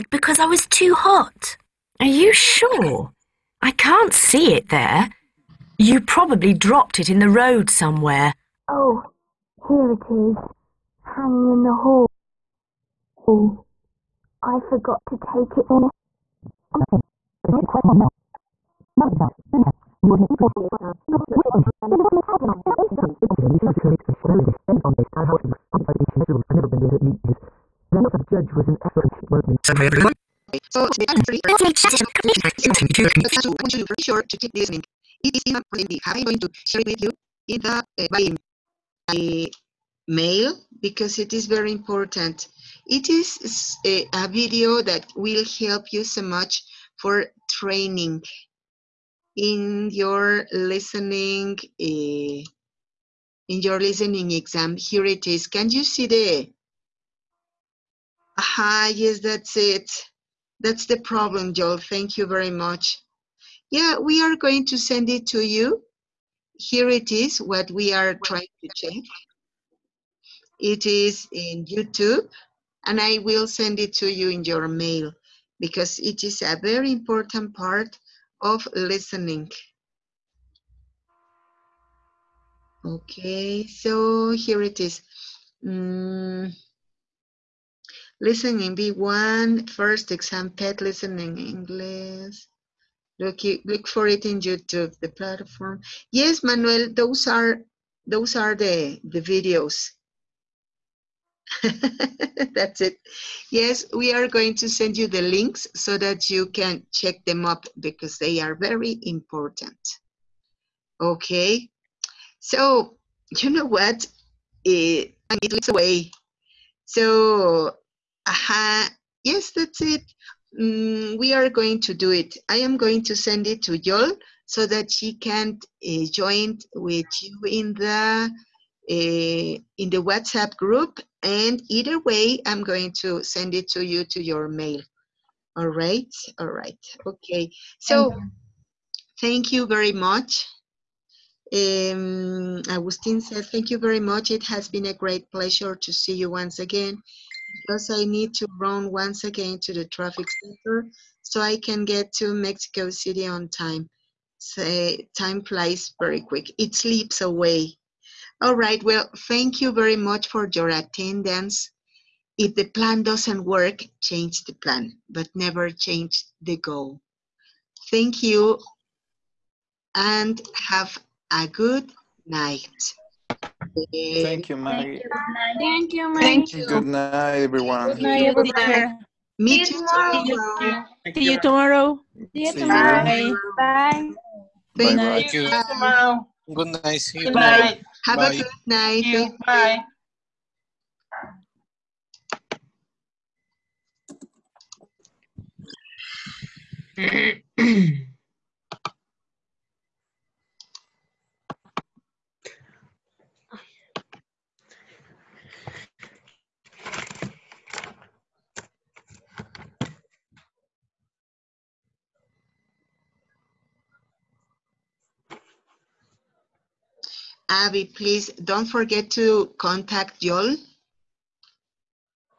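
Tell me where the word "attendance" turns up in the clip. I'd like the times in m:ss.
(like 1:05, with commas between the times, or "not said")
2:40.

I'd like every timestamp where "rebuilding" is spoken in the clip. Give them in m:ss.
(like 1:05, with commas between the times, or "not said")
not said.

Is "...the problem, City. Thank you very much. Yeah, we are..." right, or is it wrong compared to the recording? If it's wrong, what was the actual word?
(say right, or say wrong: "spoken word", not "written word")
wrong: "Joel", not "City".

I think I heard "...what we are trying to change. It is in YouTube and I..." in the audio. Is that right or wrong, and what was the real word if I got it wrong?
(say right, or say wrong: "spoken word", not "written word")
right.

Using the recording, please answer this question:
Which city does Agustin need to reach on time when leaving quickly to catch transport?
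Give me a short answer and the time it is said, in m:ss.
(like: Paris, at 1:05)
Mexico City, at 2:32.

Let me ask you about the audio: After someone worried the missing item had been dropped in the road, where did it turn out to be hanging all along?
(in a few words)
the hall.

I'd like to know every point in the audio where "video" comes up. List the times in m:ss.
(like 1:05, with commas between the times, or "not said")
0:44, 1:39.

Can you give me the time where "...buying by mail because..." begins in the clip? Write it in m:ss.
0:38.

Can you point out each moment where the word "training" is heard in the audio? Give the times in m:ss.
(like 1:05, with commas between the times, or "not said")
0:47.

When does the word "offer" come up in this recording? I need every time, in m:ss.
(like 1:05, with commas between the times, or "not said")
0:28.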